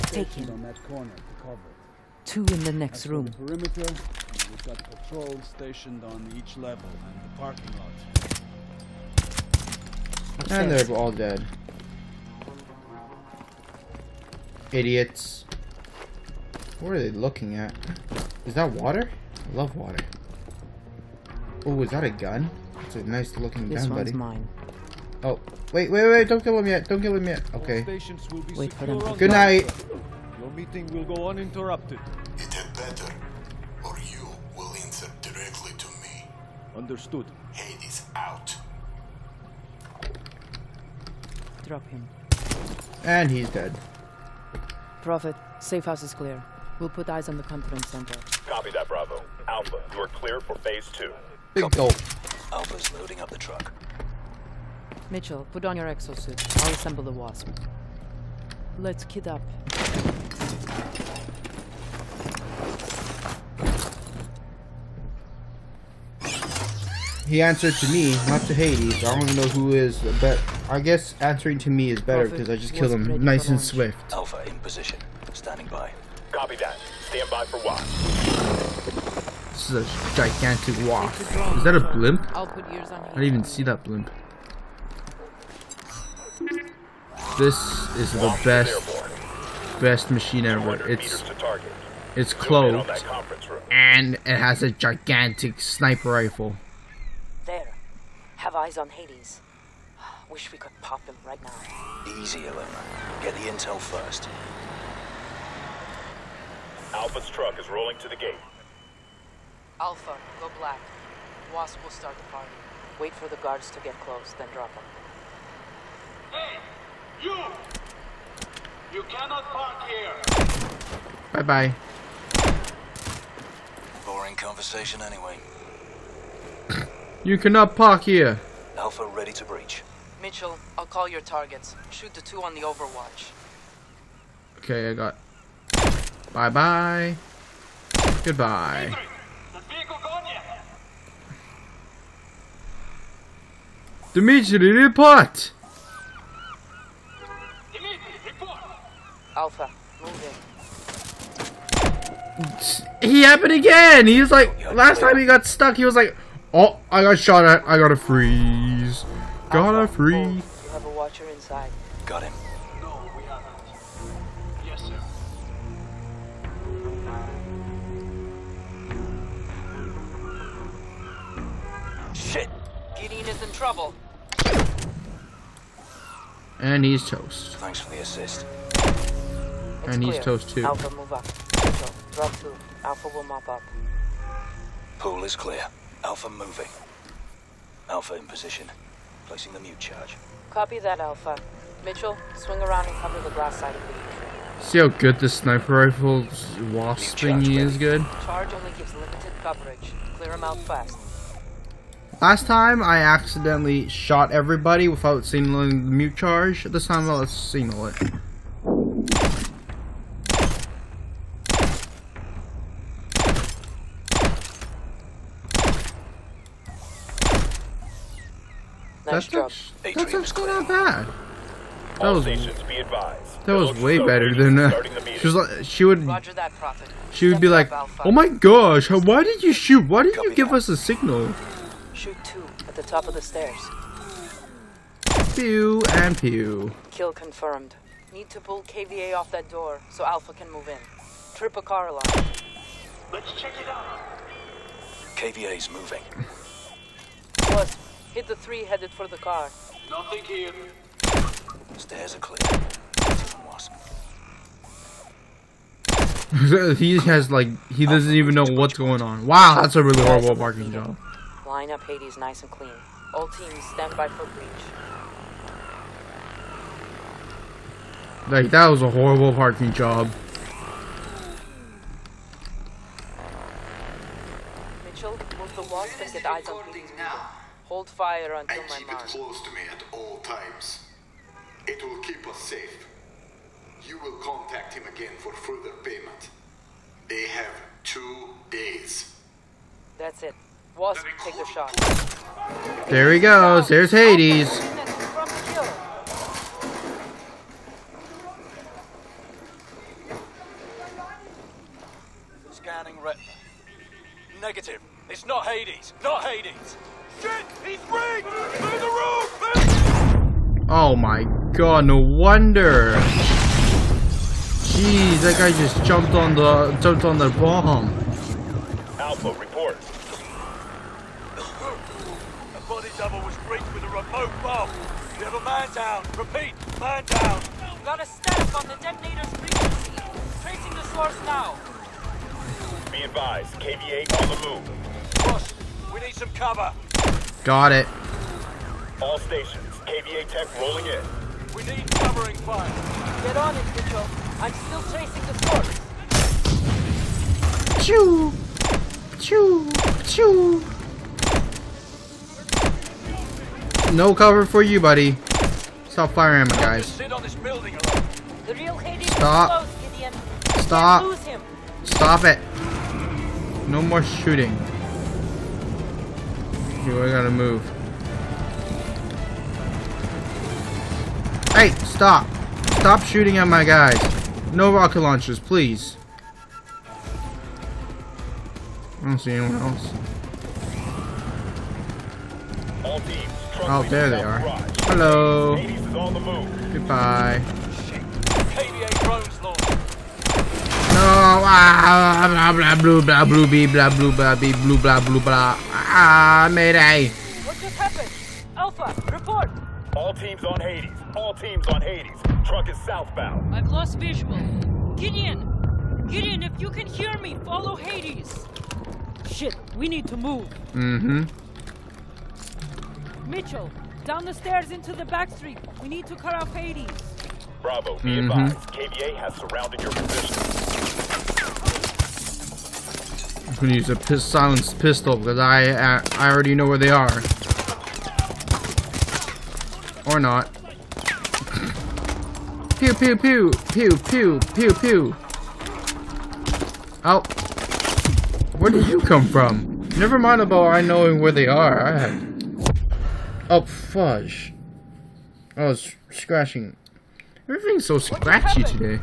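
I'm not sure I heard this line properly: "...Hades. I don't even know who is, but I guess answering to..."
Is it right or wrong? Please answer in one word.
right.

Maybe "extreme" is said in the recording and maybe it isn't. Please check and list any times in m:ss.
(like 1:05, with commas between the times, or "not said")
not said.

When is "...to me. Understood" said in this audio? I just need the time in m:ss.
0:35.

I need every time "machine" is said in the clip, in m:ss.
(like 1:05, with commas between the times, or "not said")
1:30.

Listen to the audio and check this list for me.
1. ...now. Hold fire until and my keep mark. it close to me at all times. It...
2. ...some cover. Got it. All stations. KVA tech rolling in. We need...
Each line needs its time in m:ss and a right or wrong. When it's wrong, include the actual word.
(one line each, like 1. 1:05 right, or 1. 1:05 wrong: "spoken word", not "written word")
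1. 4:36 right
2. 5:36 right.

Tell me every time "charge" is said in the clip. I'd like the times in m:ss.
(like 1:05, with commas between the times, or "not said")
3:09, 3:18, 3:26.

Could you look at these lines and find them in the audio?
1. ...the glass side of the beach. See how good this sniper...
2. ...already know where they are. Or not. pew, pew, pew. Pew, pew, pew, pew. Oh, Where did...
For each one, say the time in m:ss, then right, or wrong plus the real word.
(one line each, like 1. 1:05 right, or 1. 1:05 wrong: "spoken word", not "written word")
1. 3:13 right
2. 7:06 right.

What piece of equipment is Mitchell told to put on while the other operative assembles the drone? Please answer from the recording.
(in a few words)
exosuit.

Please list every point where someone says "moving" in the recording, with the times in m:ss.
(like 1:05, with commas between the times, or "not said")
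3:06, 4:05.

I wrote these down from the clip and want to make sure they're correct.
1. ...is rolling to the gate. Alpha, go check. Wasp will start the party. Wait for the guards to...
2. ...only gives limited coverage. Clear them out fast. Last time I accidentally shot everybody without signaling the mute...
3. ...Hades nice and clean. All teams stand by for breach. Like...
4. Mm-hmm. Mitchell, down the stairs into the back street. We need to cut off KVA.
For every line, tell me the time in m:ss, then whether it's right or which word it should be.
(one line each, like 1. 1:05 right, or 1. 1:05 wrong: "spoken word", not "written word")
1. 1:47 wrong: "black", not "check"
2. 3:18 right
3. 4:21 right
4. 6:50 wrong: "Hades", not "KVA".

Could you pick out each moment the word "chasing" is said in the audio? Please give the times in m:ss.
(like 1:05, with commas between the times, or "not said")
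5:44.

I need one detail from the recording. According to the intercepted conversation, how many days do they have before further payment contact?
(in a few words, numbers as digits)
2.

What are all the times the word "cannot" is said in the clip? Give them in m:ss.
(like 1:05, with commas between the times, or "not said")
1:59, 2:07.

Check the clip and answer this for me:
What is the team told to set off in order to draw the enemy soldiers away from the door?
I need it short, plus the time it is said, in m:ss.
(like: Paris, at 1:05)
a car alarm, at 4:01.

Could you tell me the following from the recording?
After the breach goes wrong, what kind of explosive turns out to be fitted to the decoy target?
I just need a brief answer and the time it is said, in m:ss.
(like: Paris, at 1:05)
remote bomb, at 5:23.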